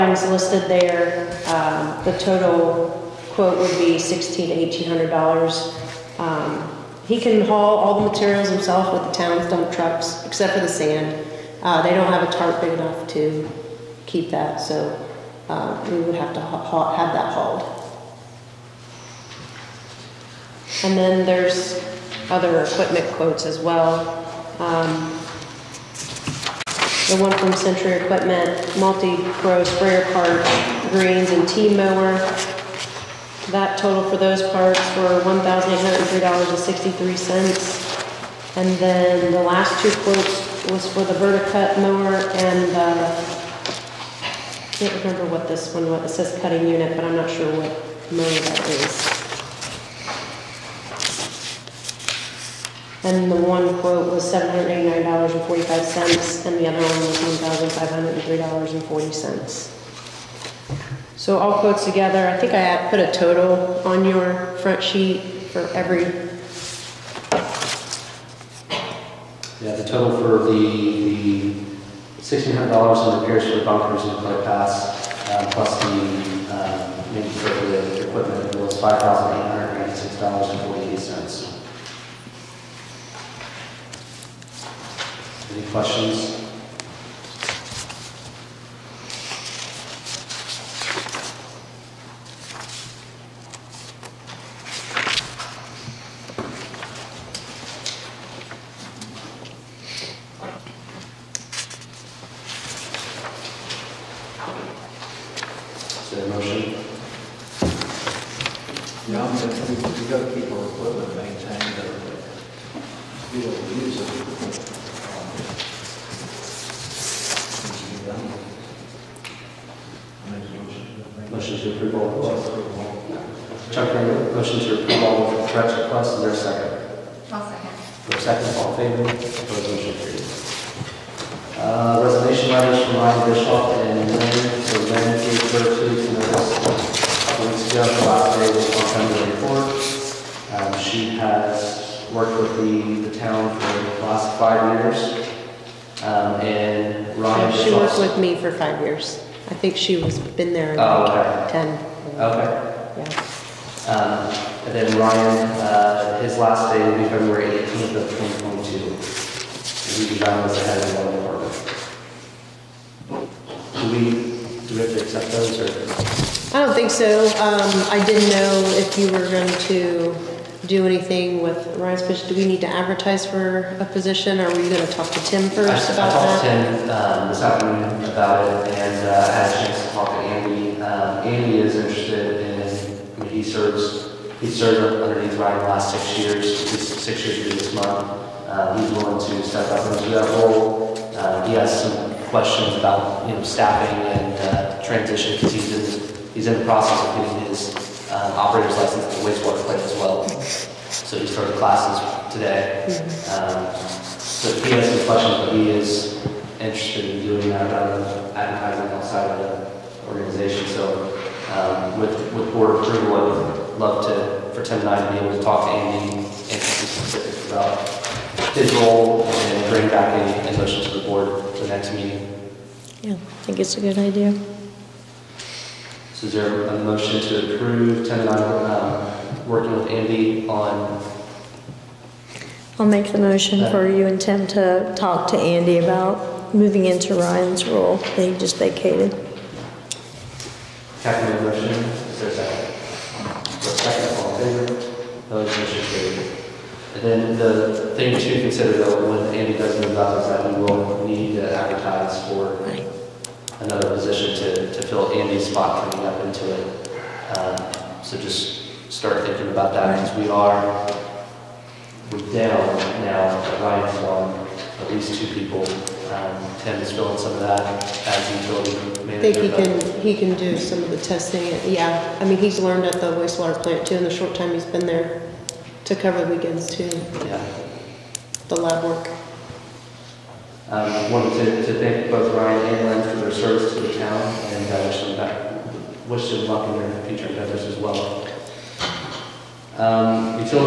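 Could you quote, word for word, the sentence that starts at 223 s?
Yeah, I think it's a good idea.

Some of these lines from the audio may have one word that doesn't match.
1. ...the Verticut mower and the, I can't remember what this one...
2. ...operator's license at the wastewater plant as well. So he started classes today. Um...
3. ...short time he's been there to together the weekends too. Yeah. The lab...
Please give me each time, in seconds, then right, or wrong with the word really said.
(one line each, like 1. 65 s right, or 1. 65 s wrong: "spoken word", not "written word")
1. 41 s right
2. 198 s right
3. 274 s wrong: "cover", not "together".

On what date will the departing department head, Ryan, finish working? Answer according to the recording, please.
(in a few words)
February 18, 2022.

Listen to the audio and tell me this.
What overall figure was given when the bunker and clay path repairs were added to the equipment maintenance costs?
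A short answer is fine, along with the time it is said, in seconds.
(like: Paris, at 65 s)
$5,896.40, at 78 s.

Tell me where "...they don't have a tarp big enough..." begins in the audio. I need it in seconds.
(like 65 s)
11 s.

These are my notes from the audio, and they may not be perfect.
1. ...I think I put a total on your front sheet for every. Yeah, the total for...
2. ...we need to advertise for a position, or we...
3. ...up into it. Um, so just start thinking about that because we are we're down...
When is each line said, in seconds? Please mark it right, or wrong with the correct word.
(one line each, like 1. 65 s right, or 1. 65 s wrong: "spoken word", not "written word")
1. 62 s right
2. 172 s right
3. 256 s right.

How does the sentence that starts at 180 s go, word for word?
Um, Andy is interested in, I mean, he serves, he served underneath Ryan the last six years, six years this month.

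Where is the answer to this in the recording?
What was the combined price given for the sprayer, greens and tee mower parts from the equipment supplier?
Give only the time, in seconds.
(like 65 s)
35 s.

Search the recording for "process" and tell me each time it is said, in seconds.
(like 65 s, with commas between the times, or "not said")
196 s.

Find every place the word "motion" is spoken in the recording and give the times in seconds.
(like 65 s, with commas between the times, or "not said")
220 s, 226 s, 233 s, 241 s, 245 s.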